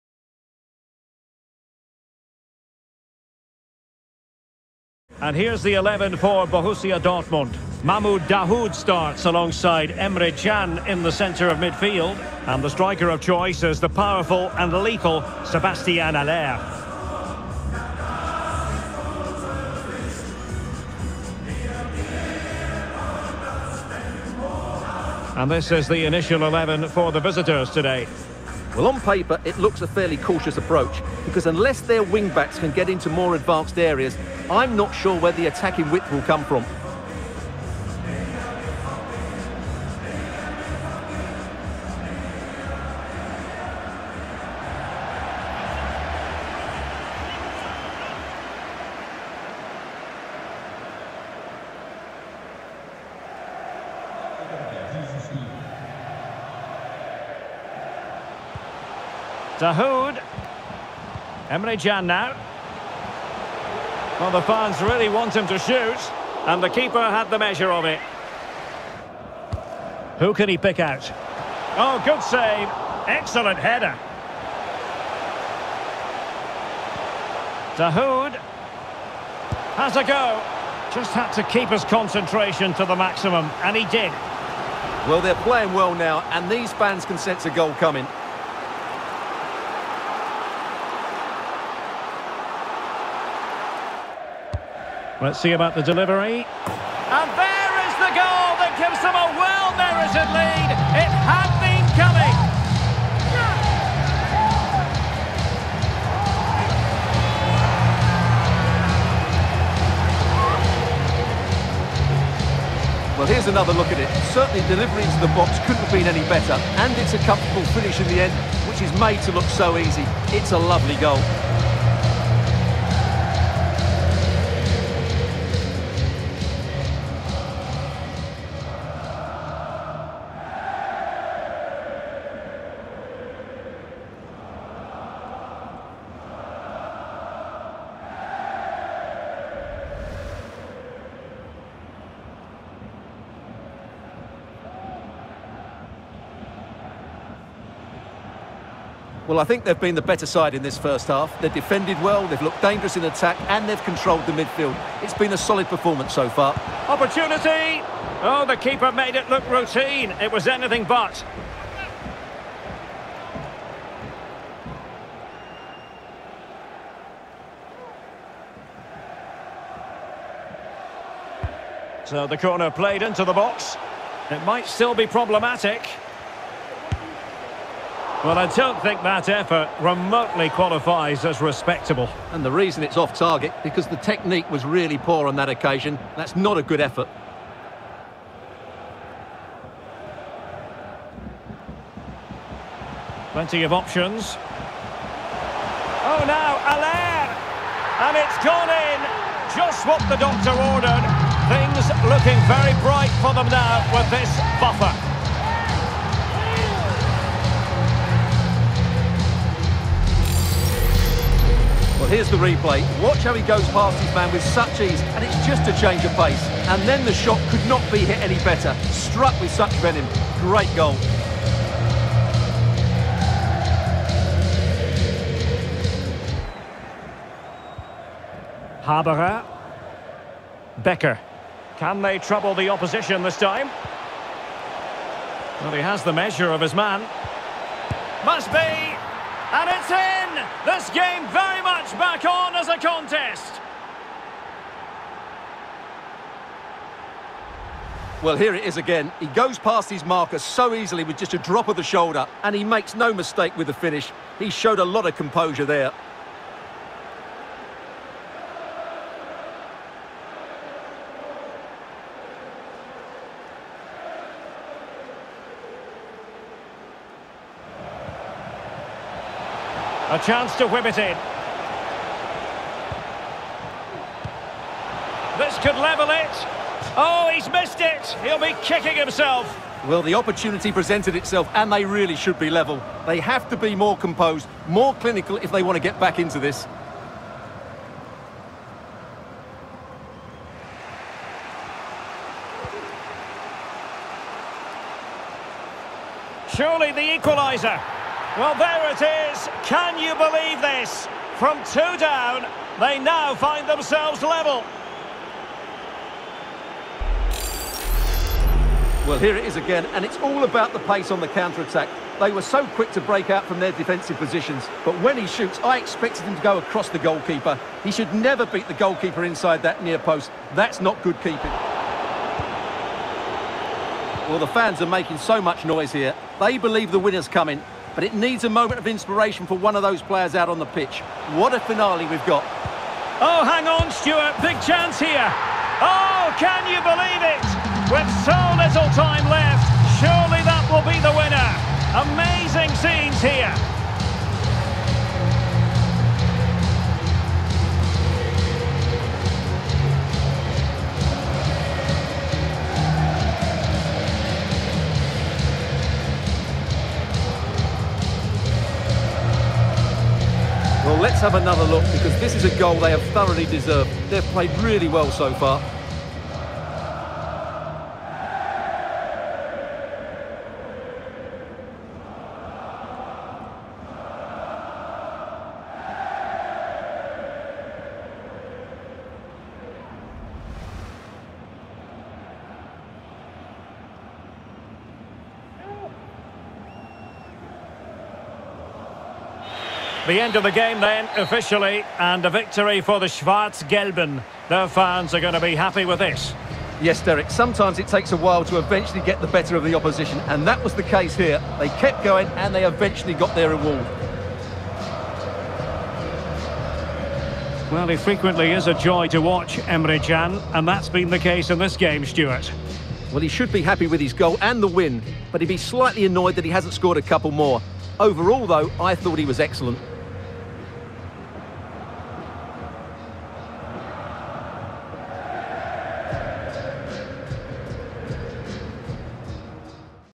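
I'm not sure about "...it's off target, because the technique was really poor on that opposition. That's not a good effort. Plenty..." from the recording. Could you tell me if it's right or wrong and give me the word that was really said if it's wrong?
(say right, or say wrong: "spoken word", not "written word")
wrong: "occasion", not "opposition".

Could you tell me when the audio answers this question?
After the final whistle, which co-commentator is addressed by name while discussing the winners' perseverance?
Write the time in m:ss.
6:37.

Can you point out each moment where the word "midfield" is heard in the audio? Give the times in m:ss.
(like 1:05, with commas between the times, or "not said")
0:11, 2:34.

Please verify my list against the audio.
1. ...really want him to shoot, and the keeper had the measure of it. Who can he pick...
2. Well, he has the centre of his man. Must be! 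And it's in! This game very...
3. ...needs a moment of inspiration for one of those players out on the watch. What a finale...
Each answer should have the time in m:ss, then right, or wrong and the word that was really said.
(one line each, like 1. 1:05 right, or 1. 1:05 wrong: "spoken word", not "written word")
1. 1:04 right
2. 3:55 wrong: "measure", not "centre"
3. 5:28 wrong: "pitch", not "watch".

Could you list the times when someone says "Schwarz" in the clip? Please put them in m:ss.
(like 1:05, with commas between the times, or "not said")
6:33.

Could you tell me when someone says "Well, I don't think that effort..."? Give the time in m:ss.
2:58.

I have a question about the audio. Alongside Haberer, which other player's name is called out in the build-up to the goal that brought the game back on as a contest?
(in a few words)
Becker.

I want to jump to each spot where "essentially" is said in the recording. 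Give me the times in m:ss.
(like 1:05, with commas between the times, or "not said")
not said.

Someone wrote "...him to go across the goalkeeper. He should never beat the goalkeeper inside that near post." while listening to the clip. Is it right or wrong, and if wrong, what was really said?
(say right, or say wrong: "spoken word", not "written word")
right.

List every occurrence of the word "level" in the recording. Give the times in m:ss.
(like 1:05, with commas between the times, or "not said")
4:35, 4:42, 5:04.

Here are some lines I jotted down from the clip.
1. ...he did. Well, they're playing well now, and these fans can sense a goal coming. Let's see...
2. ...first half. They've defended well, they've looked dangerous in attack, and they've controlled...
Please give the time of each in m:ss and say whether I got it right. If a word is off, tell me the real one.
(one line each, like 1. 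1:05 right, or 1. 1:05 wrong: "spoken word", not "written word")
1. 1:23 right
2. 2:30 right.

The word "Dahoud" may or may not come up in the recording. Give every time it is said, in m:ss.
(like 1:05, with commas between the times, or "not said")
0:08, 0:59, 1:17.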